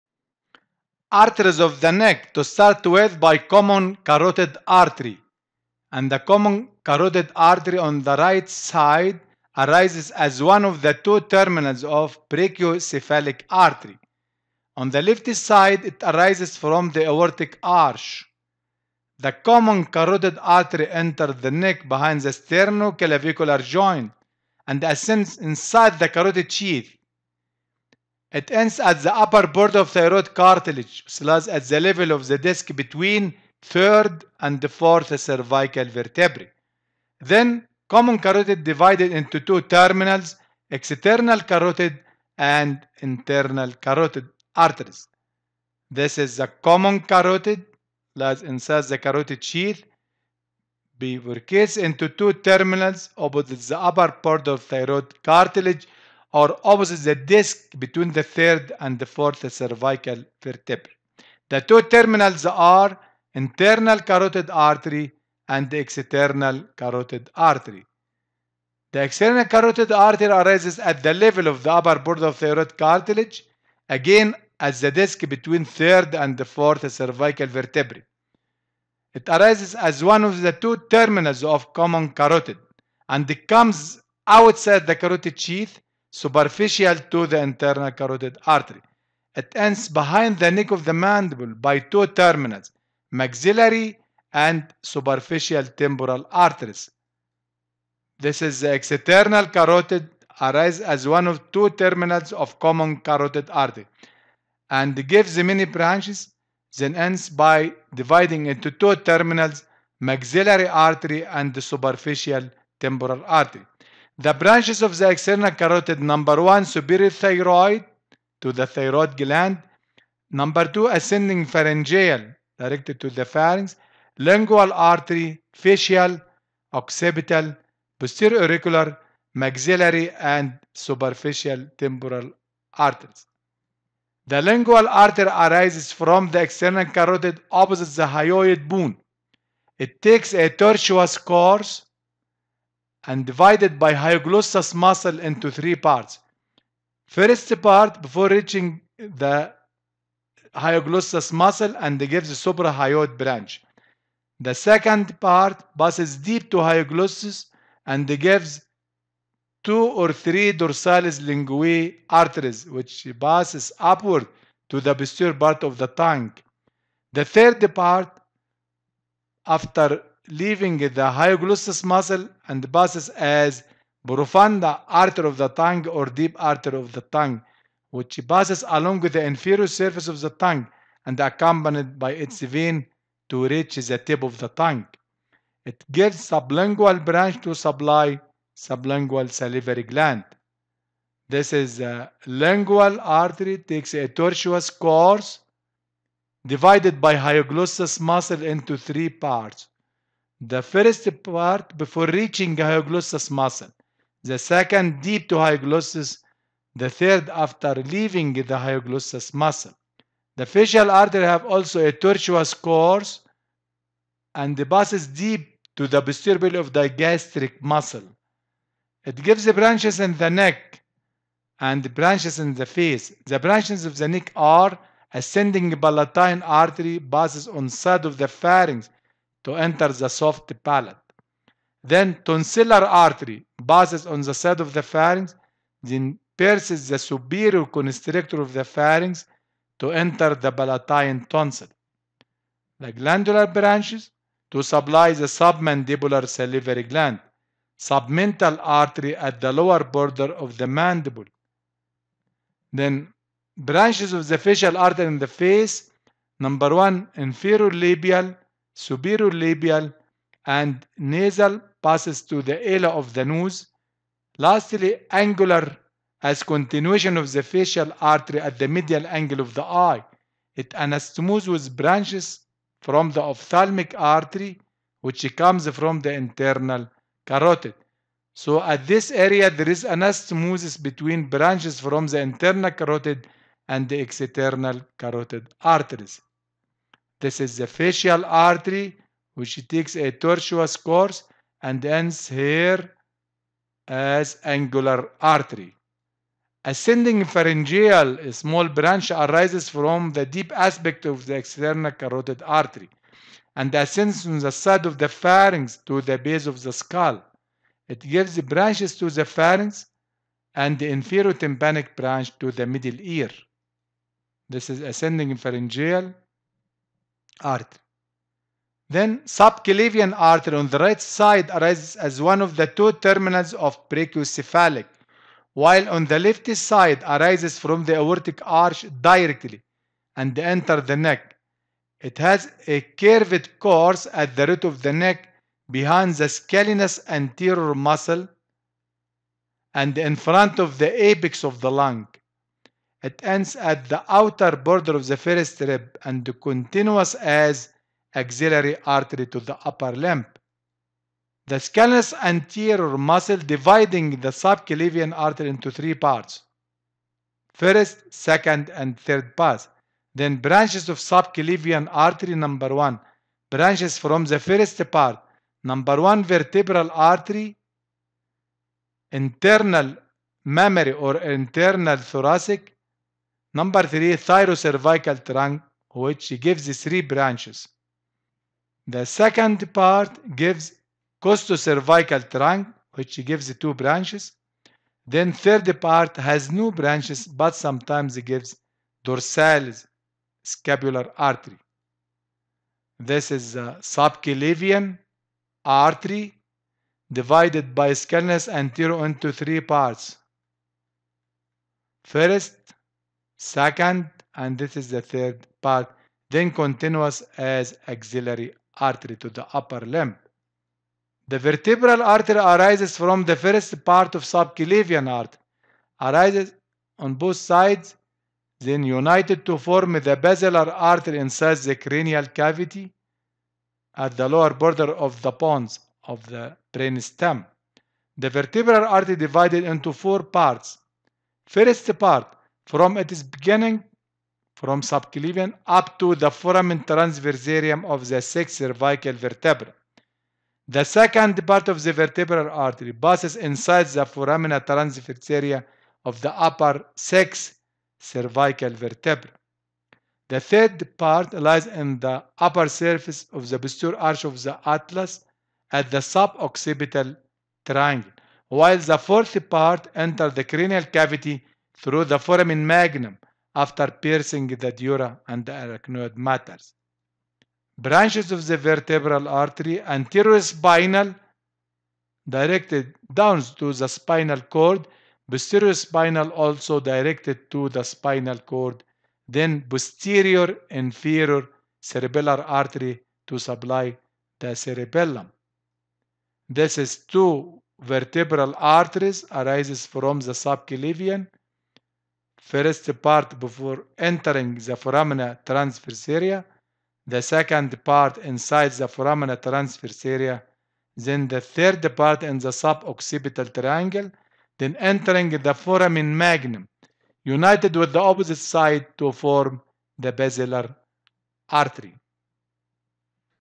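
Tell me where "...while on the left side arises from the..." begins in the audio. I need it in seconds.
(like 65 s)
325 s.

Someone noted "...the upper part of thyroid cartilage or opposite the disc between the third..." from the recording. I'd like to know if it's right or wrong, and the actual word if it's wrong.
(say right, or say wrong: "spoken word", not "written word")
right.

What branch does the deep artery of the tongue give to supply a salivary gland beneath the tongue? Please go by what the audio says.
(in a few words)
Sublingual branch.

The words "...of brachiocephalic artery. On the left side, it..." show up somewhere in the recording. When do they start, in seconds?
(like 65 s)
11 s.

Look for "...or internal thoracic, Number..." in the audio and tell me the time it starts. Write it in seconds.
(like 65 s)
370 s.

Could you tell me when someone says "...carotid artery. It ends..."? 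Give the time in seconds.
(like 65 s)
87 s.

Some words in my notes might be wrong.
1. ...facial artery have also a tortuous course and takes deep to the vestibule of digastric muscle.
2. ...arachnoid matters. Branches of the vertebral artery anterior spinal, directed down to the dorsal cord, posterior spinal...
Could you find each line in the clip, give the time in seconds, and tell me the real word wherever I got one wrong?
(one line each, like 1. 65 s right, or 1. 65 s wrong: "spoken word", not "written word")
1. 210 s wrong: "passes", not "takes"
2. 465 s wrong: "spinal", not "dorsal".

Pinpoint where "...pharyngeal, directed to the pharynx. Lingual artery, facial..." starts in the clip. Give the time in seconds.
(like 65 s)
121 s.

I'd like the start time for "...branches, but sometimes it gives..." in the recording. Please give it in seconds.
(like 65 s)
386 s.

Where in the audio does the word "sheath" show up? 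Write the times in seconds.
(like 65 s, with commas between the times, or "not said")
26 s, 49 s, 85 s.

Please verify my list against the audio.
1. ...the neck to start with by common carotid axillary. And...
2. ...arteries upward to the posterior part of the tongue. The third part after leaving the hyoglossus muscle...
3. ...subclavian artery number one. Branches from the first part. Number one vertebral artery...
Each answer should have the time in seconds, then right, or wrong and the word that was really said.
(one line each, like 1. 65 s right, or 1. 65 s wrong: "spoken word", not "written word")
1. 1 s wrong: "artery", not "axillary"
2. 163 s wrong: "passes", not "arteries"
3. 360 s right.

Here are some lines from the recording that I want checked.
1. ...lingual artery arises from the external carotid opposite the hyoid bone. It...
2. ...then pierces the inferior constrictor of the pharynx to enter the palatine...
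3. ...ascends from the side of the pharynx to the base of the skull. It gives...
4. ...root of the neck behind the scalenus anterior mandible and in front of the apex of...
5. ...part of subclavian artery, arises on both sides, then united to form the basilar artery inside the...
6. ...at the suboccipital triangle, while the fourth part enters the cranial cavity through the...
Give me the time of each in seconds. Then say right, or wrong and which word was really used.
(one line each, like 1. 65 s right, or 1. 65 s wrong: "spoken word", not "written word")
1. 134 s right
2. 235 s wrong: "superior", not "inferior"
3. 303 s right
4. 334 s wrong: "muscle", not "mandible"
5. 413 s right
6. 455 s right.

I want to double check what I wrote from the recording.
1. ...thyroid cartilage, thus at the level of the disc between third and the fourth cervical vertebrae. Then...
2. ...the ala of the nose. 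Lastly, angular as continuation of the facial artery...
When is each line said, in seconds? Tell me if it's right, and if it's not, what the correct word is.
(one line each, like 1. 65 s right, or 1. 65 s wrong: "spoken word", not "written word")
1. 29 s right
2. 262 s right.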